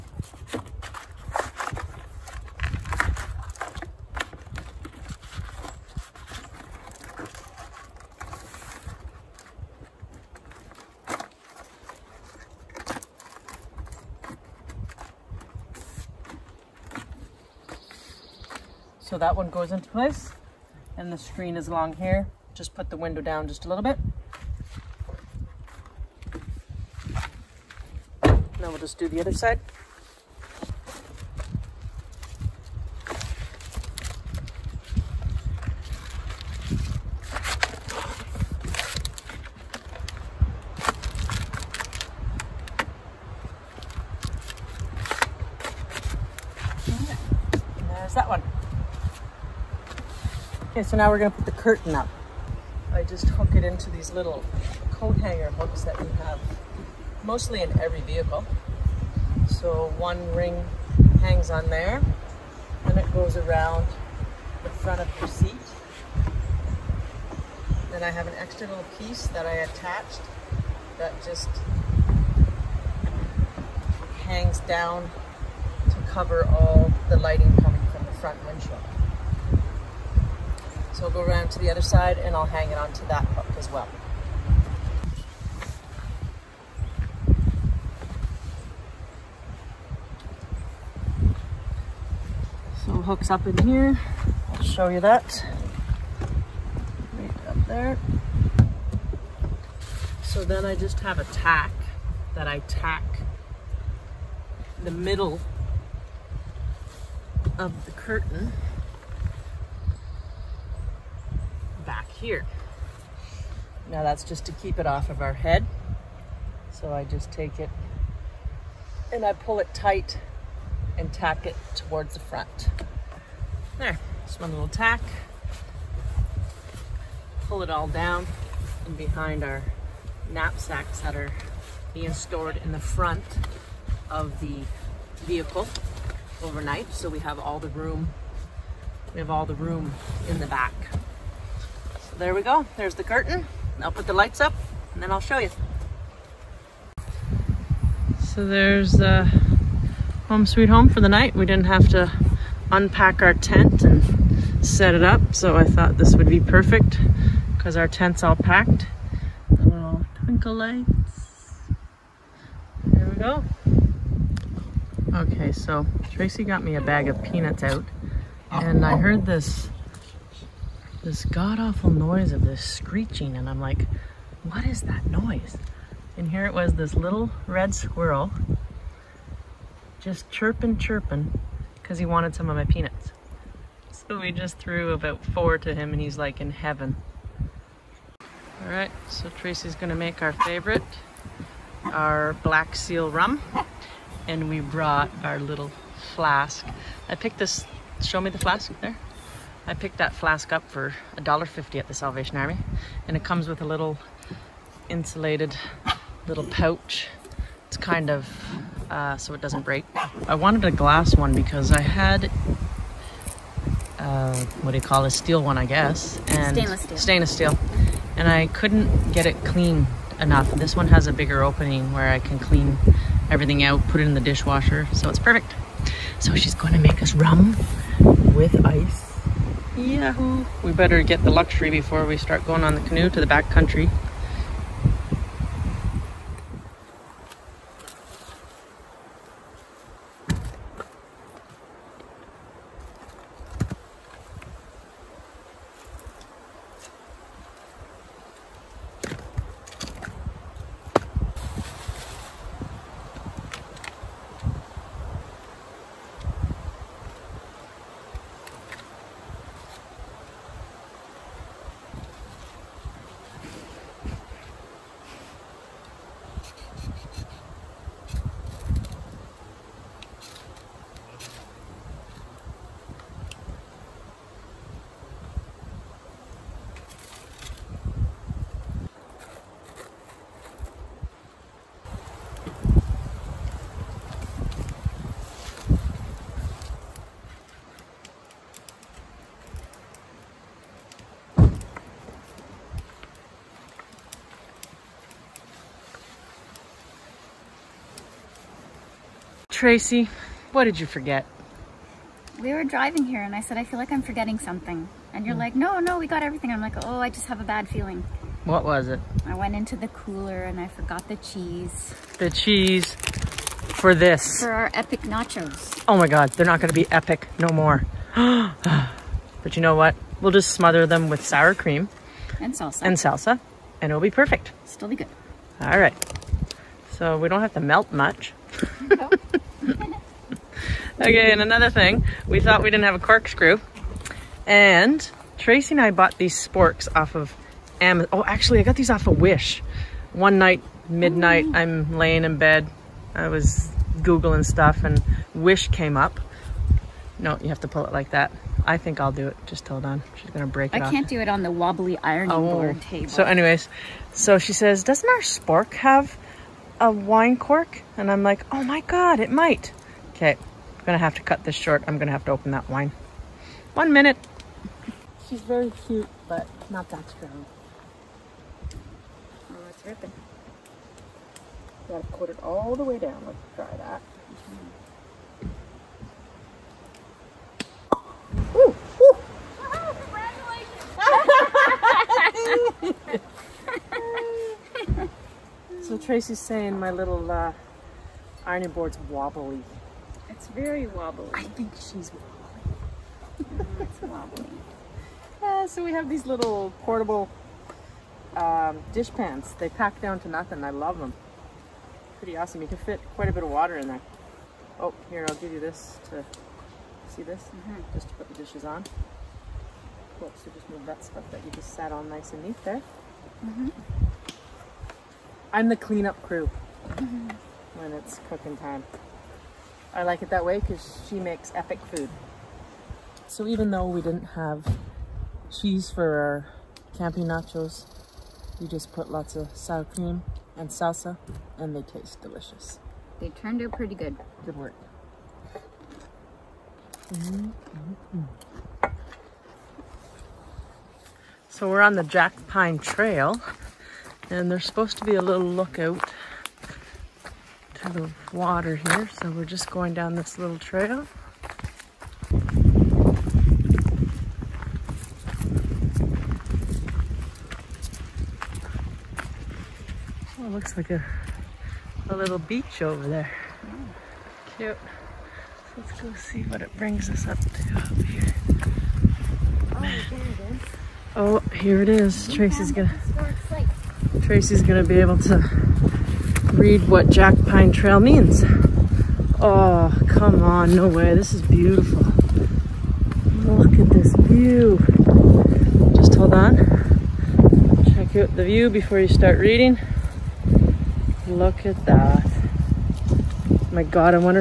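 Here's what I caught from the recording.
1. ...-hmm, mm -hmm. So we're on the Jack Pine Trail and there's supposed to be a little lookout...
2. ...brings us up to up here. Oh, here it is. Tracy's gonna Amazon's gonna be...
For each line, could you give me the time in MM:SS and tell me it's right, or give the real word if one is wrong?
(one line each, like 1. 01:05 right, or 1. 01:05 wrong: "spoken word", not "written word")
1. 07:17 right
2. 07:46 wrong: "Tracy", not "Amazon".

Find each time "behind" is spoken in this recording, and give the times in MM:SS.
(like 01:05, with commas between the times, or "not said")
02:08.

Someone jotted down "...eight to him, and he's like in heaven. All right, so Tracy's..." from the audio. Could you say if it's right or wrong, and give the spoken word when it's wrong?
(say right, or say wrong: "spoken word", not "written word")
wrong: "four", not "eight".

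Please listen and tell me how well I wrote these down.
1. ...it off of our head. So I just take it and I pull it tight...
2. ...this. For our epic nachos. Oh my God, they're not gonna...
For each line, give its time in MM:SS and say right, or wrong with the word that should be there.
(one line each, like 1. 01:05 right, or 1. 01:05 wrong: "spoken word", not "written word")
1. 01:54 right
2. 05:13 right.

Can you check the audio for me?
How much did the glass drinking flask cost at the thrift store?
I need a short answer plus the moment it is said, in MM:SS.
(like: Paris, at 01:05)
$1.50, at 03:21.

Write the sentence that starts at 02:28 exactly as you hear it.
So there's the uh, home sweet home for the night.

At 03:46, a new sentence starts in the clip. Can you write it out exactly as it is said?
So she's going to make us rum with ice.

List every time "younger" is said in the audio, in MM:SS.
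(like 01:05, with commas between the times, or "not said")
not said.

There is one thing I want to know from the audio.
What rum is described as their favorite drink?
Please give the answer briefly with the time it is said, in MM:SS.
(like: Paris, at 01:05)
Black seal rum, at 03:12.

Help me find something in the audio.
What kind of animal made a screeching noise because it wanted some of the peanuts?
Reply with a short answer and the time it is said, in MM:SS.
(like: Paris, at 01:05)
Red squirrel, at 02:57.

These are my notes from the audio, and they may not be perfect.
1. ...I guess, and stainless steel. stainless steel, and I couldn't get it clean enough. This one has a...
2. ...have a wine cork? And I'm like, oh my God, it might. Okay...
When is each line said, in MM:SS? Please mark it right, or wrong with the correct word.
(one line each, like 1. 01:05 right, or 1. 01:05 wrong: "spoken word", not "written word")
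1. 03:35 right
2. 05:55 right.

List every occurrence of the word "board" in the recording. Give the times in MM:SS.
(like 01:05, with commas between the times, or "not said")
05:52, 06:28.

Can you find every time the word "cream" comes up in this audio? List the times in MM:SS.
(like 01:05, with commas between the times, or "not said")
05:21, 07:09.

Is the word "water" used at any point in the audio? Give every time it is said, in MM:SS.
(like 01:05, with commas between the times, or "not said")
06:43, 07:28.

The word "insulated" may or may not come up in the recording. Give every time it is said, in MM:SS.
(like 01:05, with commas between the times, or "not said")
03:24.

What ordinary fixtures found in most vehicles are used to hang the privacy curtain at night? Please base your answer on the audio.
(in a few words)
Coat hanger hooks.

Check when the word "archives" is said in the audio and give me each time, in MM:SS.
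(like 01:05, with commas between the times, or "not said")
not said.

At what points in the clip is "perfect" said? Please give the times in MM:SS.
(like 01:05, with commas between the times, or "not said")
02:36, 03:45, 05:24.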